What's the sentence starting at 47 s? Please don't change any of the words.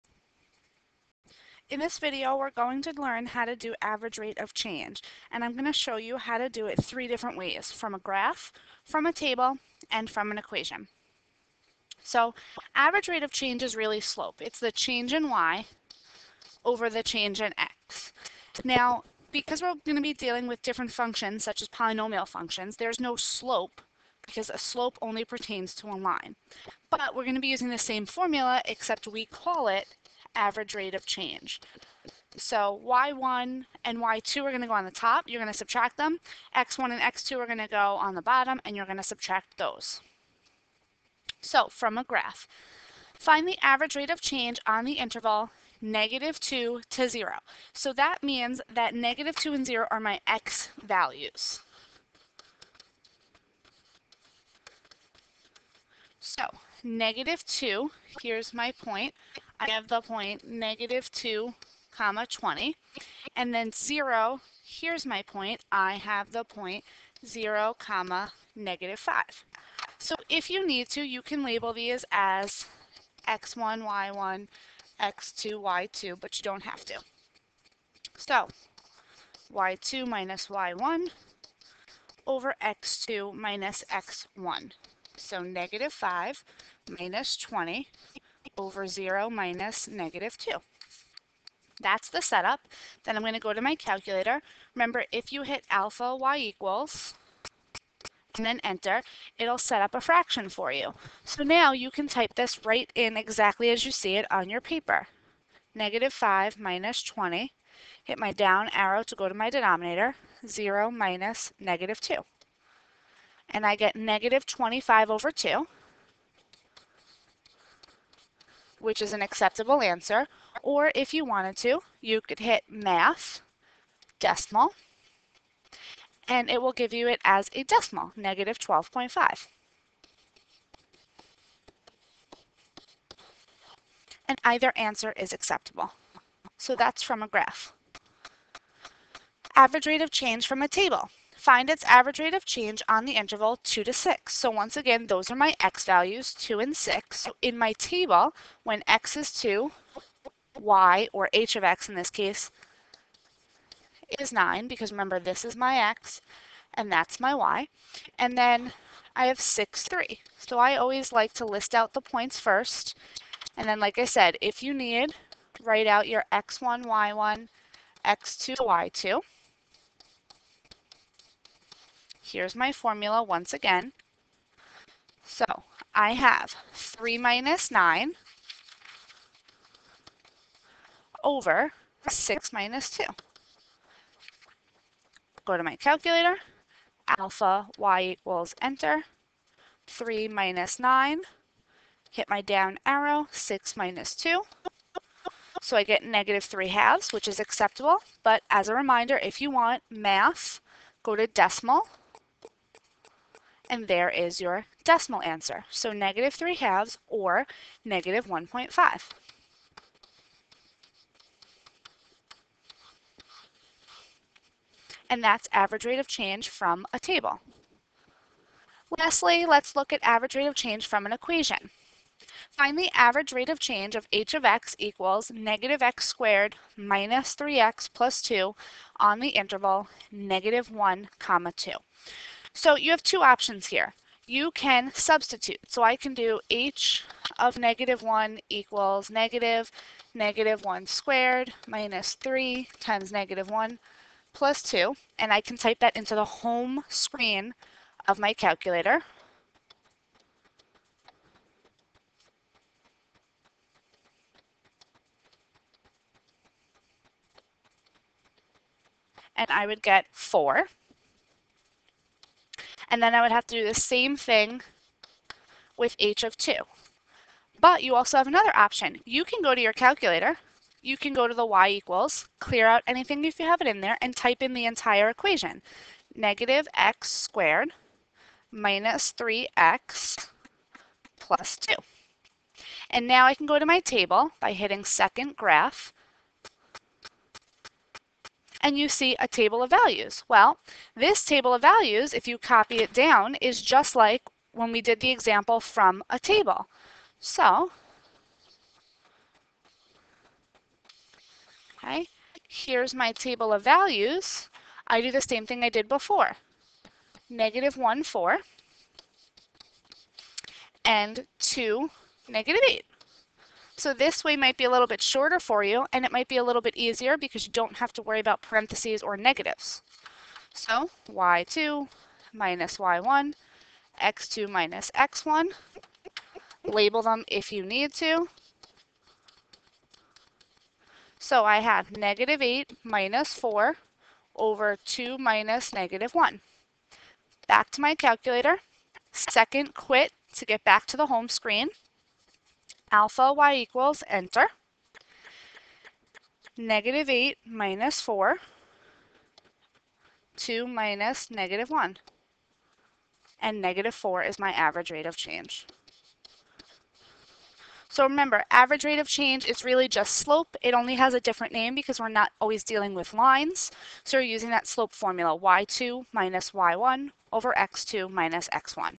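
So that means that negative 2 and 0 are my x values.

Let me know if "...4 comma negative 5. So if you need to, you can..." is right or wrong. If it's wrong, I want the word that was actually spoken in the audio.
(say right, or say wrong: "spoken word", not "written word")
wrong: "0", not "4".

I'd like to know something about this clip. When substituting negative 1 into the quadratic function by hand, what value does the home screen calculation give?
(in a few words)
4.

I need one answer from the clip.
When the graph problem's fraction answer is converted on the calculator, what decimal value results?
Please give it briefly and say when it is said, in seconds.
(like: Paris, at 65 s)
-12.5, at 128 s.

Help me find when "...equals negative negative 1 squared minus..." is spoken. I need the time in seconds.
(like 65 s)
238 s.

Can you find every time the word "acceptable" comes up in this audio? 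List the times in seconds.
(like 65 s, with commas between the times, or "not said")
119 s, 135 s, 197 s.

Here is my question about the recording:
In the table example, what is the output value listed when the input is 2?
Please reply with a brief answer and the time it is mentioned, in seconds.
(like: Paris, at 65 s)
9, at 154 s.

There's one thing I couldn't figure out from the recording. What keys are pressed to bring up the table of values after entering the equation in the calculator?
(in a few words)
second graph.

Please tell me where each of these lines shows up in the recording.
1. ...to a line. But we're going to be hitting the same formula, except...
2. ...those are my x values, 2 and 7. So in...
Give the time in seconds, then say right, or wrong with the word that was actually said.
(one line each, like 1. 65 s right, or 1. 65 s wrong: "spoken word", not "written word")
1. 25 s wrong: "using", not "hitting"
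2. 145 s wrong: "6", not "7".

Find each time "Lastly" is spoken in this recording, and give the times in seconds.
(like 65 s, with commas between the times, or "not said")
218 s.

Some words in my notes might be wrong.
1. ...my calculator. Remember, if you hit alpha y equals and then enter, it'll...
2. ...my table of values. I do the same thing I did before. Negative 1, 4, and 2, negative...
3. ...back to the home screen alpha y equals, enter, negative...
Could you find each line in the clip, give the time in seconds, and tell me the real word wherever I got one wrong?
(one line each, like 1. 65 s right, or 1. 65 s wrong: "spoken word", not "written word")
1. 93 s right
2. 302 s right
3. 340 s right.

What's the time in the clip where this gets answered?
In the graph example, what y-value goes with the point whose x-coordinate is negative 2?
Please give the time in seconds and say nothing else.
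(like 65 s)
60 s.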